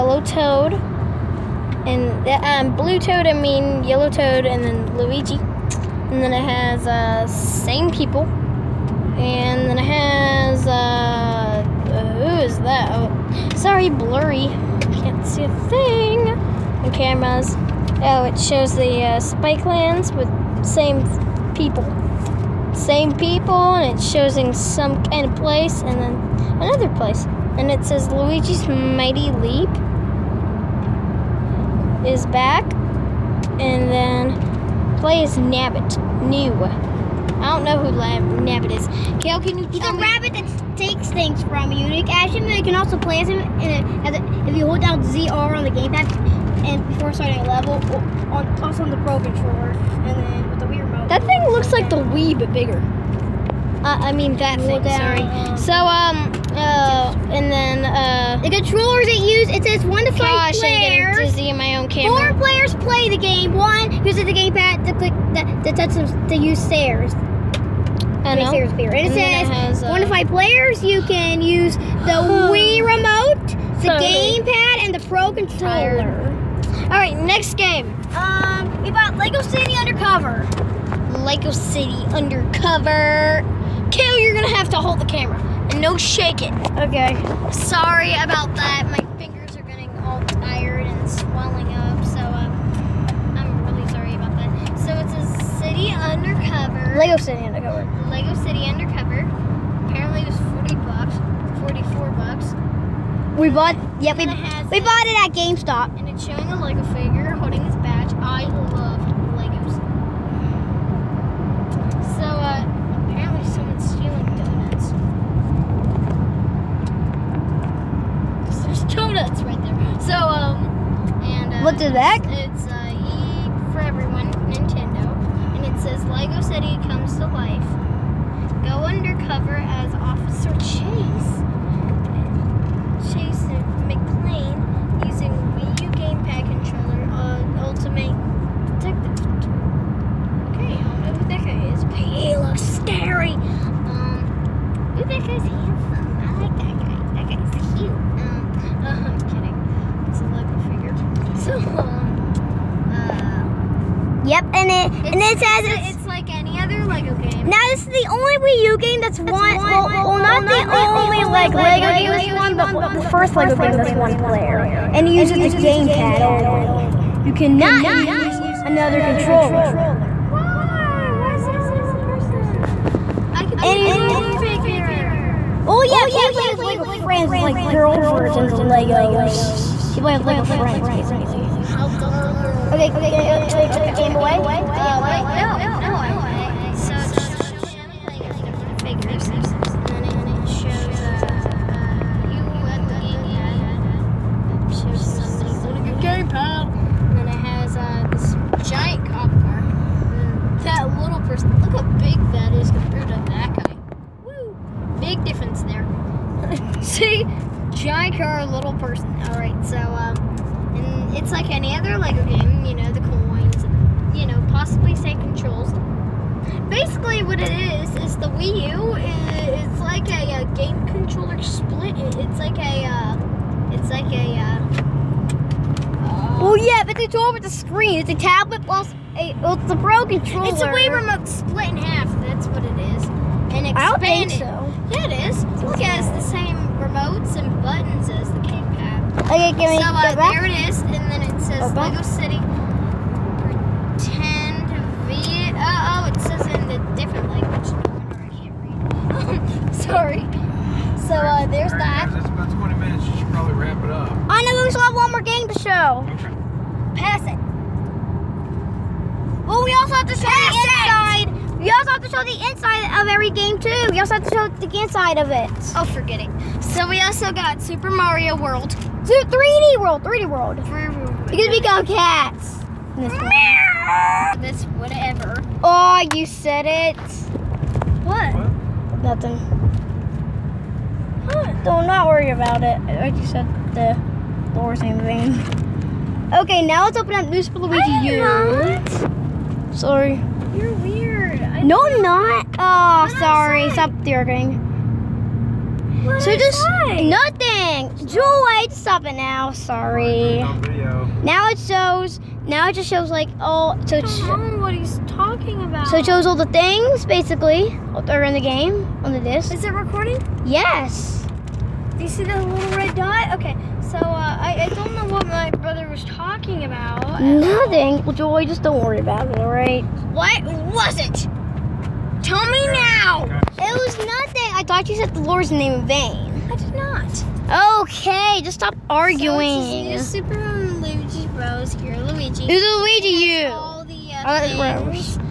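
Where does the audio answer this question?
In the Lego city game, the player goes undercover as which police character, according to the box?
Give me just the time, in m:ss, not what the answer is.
2:09.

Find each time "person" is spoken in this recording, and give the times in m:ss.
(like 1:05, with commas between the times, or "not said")
2:52, 3:21, 3:28.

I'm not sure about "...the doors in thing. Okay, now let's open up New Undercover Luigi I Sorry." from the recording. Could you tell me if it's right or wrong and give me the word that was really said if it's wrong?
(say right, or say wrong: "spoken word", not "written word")
wrong: "Super", not "Undercover".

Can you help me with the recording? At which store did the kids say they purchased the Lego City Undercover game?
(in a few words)
GameStop.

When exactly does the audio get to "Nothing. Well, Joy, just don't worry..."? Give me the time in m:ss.
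5:17.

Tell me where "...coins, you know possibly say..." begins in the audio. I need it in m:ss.
3:32.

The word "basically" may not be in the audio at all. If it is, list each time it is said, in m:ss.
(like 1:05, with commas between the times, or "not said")
3:00, 3:36, 5:07.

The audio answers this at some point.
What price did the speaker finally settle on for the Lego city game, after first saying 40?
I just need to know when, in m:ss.
1:41.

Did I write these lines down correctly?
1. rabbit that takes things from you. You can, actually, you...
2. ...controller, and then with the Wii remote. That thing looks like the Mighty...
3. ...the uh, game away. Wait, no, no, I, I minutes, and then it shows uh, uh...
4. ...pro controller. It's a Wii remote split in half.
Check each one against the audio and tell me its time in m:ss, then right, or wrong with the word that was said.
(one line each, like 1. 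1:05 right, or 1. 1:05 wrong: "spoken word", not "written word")
1. 0:40 right
2. 0:49 wrong: "Wii", not "Mighty"
3. 3:04 wrong: "figures", not "minutes"
4. 3:49 right.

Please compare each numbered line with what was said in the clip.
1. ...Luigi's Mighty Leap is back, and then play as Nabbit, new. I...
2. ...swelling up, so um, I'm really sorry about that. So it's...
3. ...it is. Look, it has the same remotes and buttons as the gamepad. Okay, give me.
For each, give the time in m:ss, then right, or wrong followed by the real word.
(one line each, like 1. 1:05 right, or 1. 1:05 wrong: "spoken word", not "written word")
1. 0:28 right
2. 1:31 right
3. 3:55 right.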